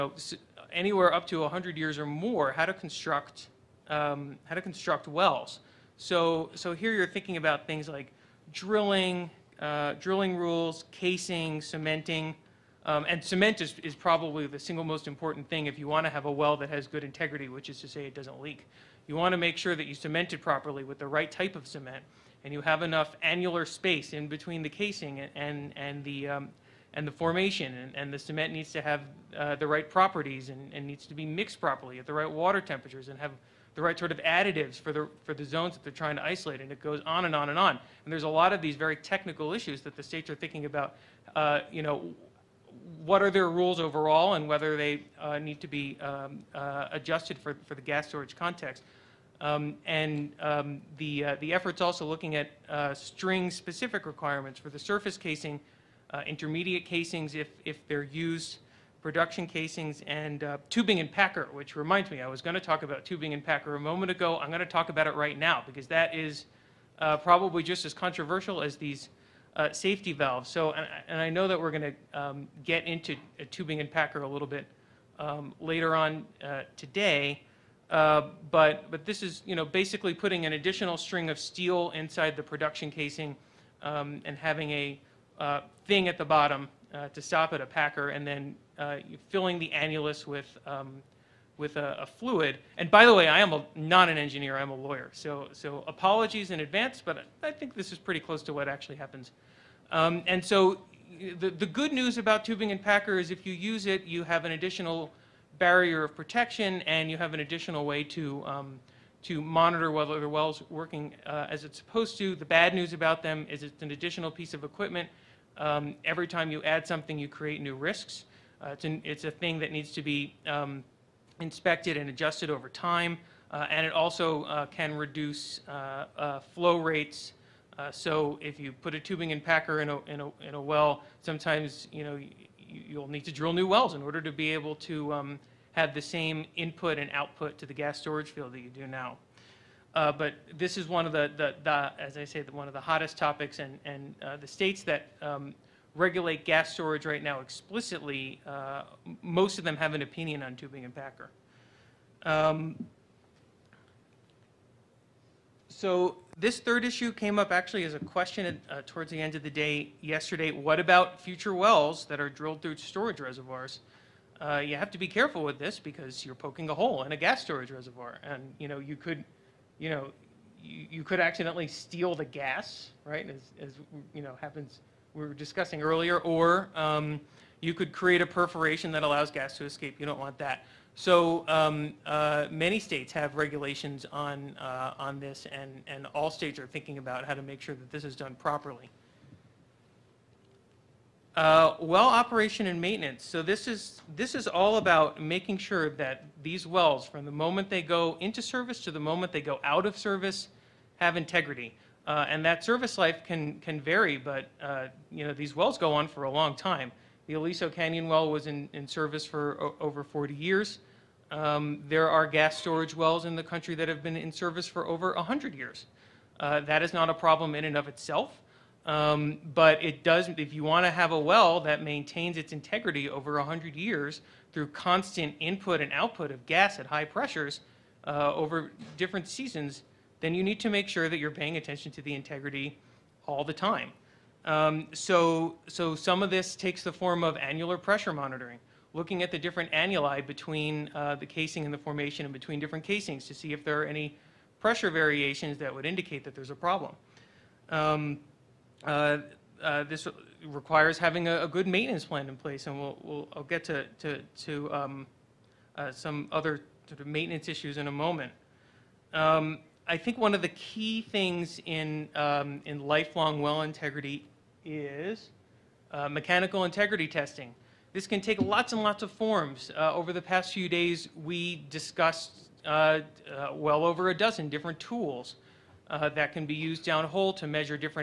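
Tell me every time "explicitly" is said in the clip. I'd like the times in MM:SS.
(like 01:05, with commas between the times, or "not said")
02:27.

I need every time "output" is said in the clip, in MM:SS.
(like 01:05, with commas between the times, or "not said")
02:17, 03:45.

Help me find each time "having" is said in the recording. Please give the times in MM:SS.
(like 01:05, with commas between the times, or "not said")
01:24, 04:10.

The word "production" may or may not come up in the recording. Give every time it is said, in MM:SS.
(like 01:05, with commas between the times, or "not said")
00:59, 01:22.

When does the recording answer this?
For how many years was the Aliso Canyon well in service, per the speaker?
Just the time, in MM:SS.
03:29.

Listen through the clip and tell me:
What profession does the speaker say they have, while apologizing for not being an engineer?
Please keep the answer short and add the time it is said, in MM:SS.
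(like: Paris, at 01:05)
Lawyer, at 01:34.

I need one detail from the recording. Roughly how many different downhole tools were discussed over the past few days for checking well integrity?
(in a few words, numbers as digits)
Over a dozen.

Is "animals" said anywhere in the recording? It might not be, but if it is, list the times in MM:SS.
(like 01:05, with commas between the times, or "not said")
not said.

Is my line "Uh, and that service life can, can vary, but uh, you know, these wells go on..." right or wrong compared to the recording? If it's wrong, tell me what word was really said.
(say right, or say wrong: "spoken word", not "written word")
right.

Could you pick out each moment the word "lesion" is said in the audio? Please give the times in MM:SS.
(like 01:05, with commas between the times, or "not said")
not said.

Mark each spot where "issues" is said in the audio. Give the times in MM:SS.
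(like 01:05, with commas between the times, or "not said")
00:39, 02:36, 04:17.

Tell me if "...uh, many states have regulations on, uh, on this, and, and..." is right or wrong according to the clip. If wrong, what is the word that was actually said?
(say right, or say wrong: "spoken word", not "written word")
right.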